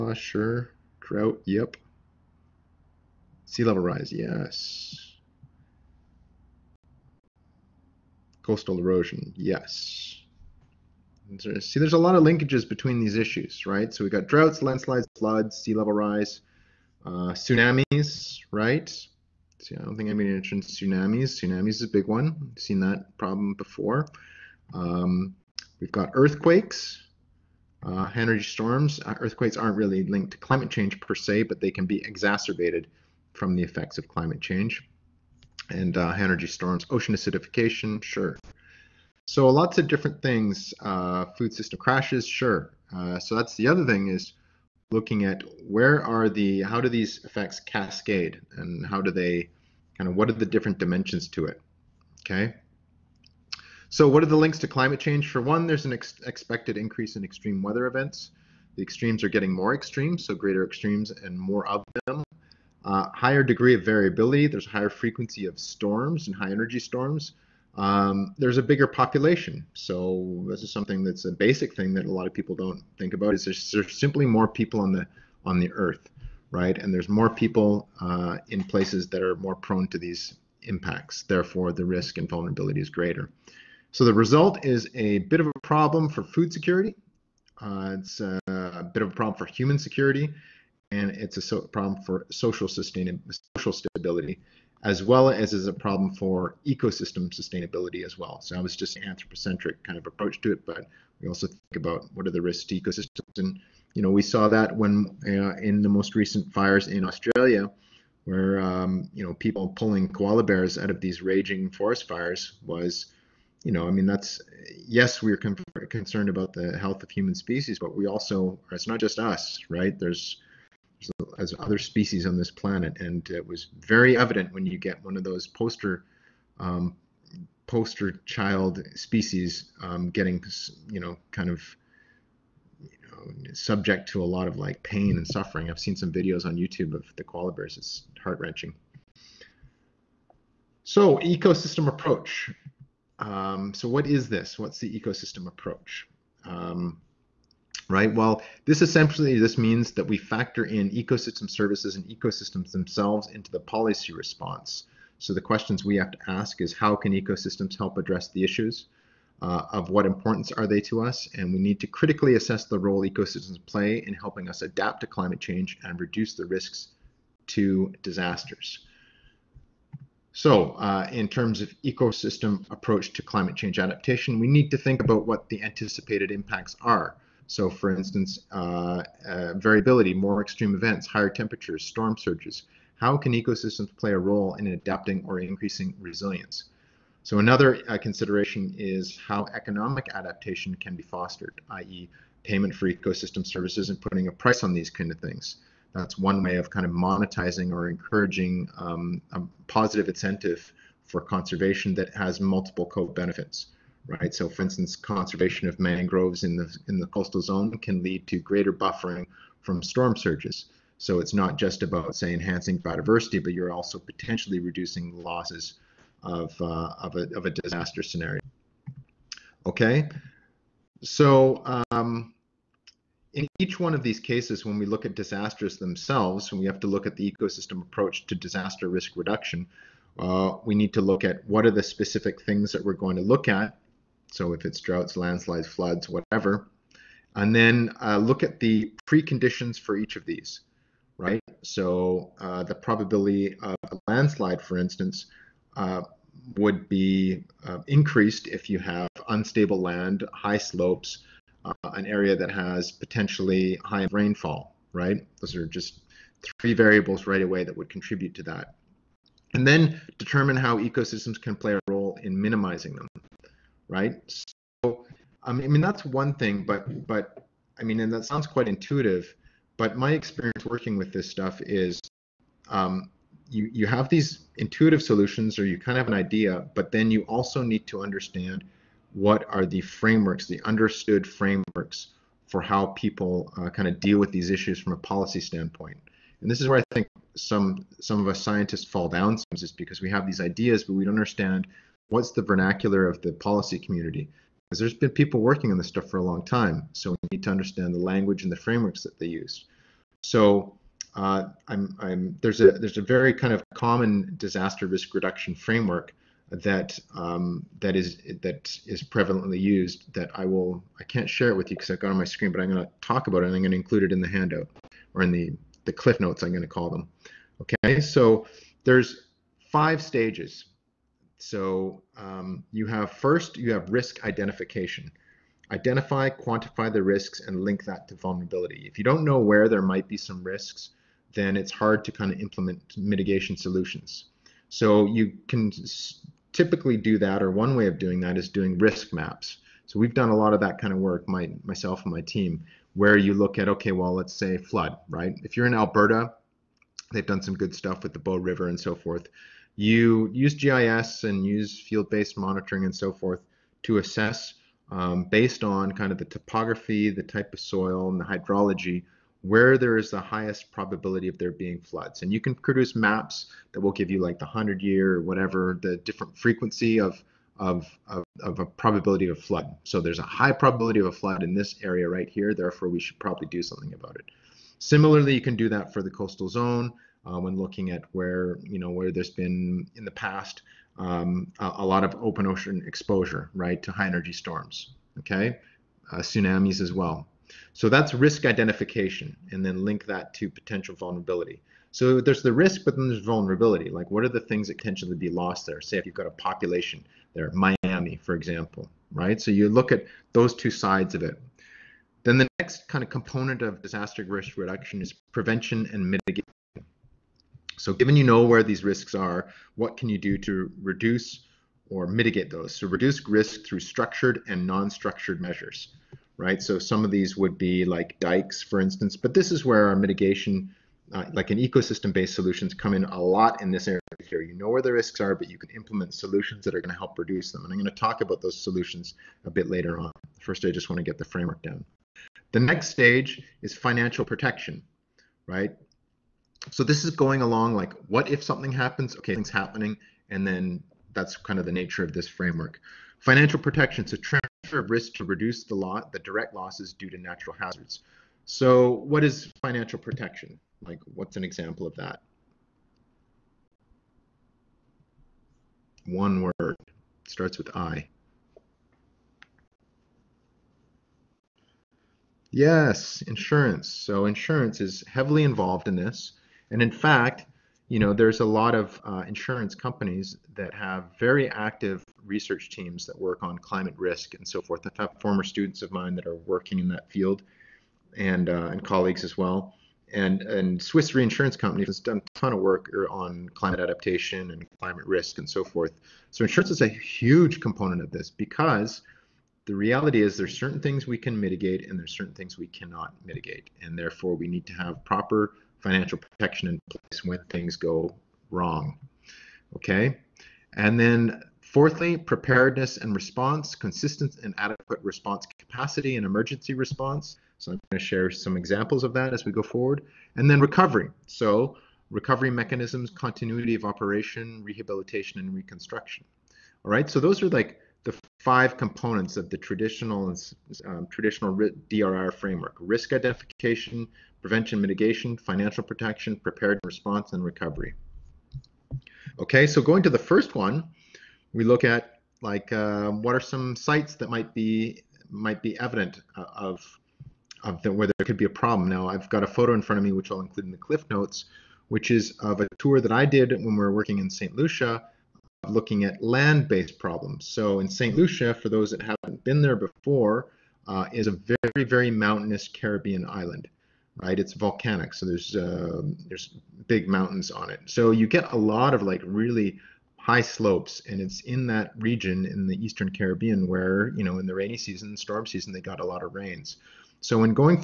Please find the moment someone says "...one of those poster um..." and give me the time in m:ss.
2:05.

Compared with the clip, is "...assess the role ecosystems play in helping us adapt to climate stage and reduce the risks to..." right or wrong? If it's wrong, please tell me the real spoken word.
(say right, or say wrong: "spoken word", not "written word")
wrong: "change", not "stage".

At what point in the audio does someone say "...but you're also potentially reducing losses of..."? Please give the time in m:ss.
3:33.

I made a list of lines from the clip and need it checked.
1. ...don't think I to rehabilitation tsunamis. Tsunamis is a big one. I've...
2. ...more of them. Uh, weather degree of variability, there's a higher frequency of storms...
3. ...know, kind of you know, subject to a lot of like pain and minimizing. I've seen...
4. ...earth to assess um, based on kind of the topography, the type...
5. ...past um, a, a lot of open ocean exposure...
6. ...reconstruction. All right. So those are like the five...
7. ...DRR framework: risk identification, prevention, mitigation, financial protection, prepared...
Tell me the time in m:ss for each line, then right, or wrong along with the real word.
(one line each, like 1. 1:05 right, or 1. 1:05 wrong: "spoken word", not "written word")
1. 0:19 wrong: "mention", not "rehabilitation"
2. 1:01 wrong: "higher", not "weather"
3. 2:10 wrong: "suffering", not "minimizing"
4. 5:53 wrong: "forth", not "earth"
5. 6:20 right
6. 8:35 right
7. 8:41 right.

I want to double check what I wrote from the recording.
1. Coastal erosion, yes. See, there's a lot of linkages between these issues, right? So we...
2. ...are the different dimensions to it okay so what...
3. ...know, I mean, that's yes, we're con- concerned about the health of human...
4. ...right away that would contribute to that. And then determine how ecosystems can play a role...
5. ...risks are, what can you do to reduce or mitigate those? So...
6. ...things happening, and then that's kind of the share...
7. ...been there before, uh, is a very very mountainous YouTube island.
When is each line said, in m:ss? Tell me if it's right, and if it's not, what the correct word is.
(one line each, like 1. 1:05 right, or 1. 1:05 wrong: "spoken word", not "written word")
1. 0:08 right
2. 0:50 right
3. 1:53 right
4. 4:17 right
5. 6:48 right
6. 7:19 wrong: "nature", not "share"
7. 9:09 wrong: "Caribbean", not "YouTube".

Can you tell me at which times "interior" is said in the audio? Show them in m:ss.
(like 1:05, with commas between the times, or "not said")
not said.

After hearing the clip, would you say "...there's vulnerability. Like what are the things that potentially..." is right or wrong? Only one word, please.
right.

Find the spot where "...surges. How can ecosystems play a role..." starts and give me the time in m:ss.
3:02.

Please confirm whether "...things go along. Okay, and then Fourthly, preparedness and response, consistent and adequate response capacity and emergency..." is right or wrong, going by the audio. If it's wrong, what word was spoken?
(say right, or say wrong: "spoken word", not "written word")
wrong: "wrong", not "along".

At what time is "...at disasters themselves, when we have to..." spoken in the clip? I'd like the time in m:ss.
3:45.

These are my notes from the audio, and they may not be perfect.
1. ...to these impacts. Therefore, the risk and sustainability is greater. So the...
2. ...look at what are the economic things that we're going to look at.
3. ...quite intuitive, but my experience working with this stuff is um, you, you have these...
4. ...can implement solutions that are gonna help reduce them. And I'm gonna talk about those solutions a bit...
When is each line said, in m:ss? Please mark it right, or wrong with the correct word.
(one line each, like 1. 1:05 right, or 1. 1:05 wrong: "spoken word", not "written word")
1. 1:19 wrong: "vulnerability", not "sustainability"
2. 3:51 wrong: "specific", not "economic"
3. 4:28 right
4. 7:05 right.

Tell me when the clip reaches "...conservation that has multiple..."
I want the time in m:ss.
3:21.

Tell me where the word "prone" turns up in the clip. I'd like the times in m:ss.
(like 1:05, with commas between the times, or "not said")
1:19.